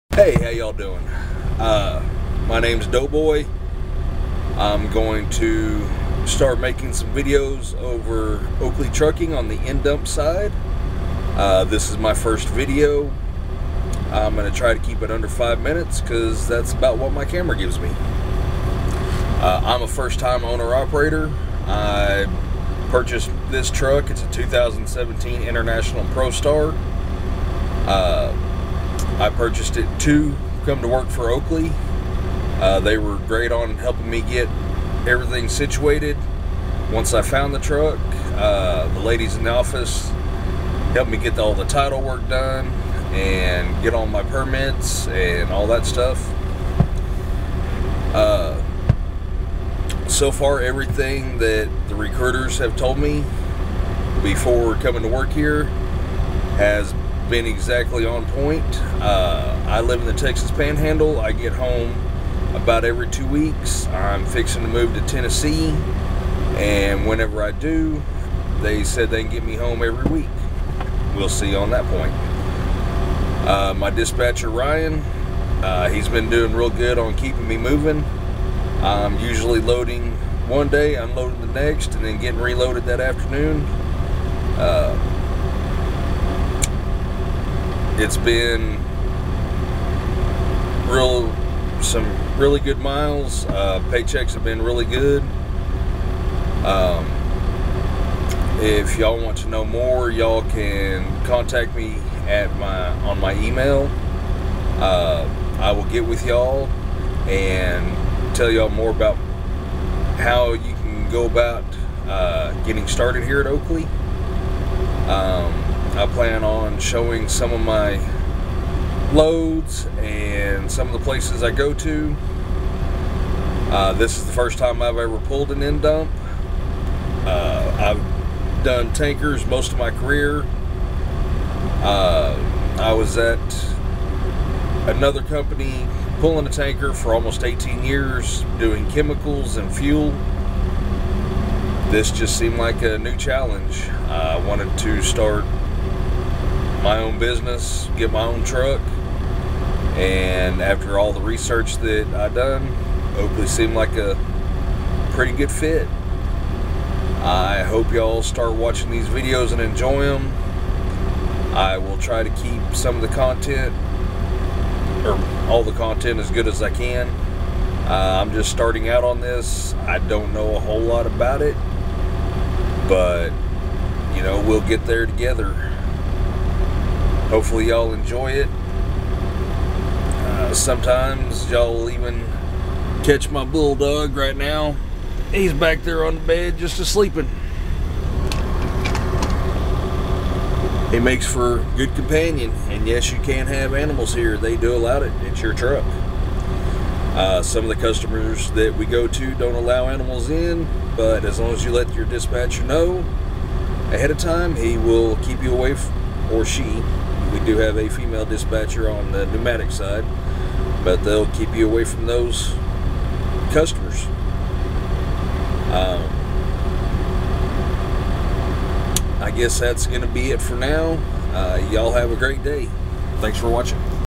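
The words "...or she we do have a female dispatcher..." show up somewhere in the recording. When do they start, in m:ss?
3:26.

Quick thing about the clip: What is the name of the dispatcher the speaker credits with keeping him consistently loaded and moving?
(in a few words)
Ryan.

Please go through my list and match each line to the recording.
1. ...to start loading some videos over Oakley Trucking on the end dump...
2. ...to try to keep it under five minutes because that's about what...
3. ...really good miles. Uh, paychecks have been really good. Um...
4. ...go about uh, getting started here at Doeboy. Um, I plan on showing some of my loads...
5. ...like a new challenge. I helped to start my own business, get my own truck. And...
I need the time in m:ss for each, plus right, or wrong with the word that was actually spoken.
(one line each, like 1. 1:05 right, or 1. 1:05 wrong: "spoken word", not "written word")
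1. 0:05 wrong: "making", not "loading"
2. 0:14 right
3. 1:32 right
4. 1:51 wrong: "Oakley", not "Doeboy"
5. 2:22 wrong: "wanted", not "helped".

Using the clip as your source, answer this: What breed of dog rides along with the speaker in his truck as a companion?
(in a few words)
Bulldog.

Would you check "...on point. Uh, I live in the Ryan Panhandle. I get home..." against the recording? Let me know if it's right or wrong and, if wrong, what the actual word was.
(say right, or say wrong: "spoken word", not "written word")
wrong: "Texas", not "Ryan".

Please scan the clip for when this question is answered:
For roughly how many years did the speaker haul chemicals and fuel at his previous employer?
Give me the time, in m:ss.
2:17.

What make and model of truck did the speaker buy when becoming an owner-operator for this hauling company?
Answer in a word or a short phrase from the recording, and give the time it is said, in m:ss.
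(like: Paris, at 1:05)
International ProStar, at 0:25.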